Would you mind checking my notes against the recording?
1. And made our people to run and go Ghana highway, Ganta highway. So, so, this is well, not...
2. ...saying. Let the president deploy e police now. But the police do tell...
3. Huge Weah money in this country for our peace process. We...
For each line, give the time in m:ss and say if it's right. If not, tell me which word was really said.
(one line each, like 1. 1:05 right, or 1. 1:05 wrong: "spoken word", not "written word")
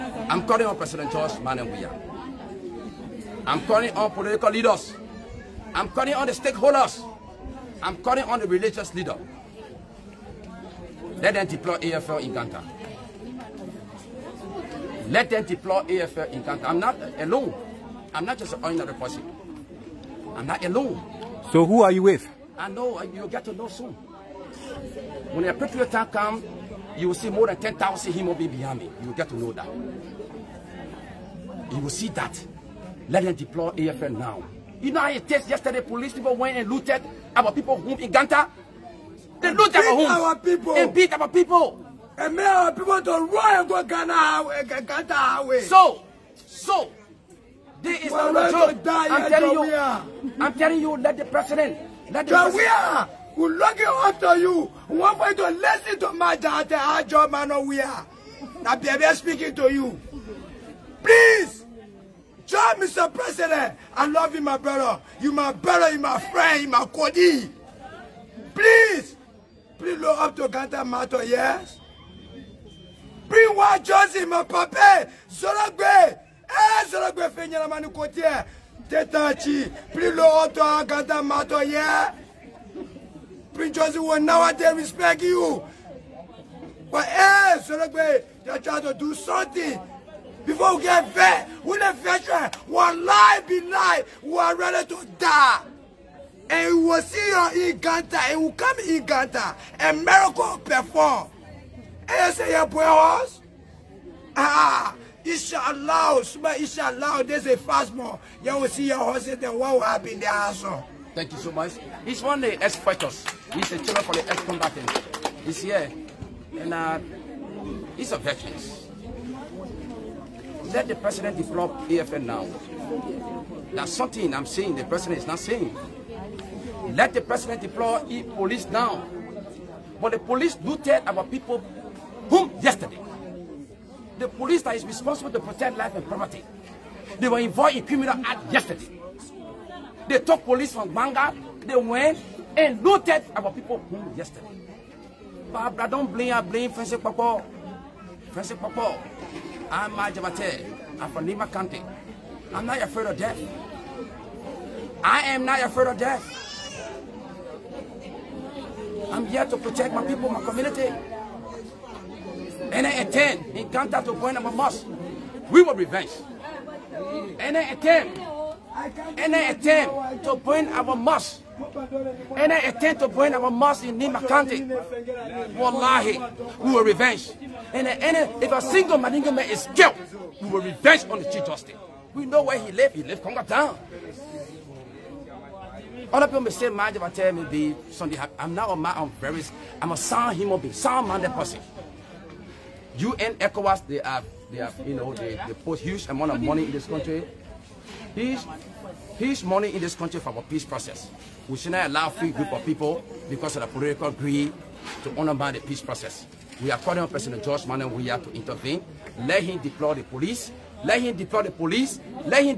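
1. 0:42 right
2. 2:05 right
3. 3:18 wrong: "Peace", not "Weah".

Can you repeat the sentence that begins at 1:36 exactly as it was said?
And we will see your in Ganta, and will come in Ganta, and miracle perform.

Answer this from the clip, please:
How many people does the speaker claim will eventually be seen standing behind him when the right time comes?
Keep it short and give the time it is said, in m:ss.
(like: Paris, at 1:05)
10,000, at 0:27.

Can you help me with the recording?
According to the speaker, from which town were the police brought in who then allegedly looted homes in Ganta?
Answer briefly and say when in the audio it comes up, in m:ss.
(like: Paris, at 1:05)
Gbarnga, at 2:20.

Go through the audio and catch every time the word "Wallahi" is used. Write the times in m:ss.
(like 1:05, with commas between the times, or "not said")
2:55.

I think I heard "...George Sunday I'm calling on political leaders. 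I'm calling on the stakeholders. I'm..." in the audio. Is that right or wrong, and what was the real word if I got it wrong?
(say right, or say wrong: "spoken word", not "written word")
wrong: "Manuel", not "Sunday".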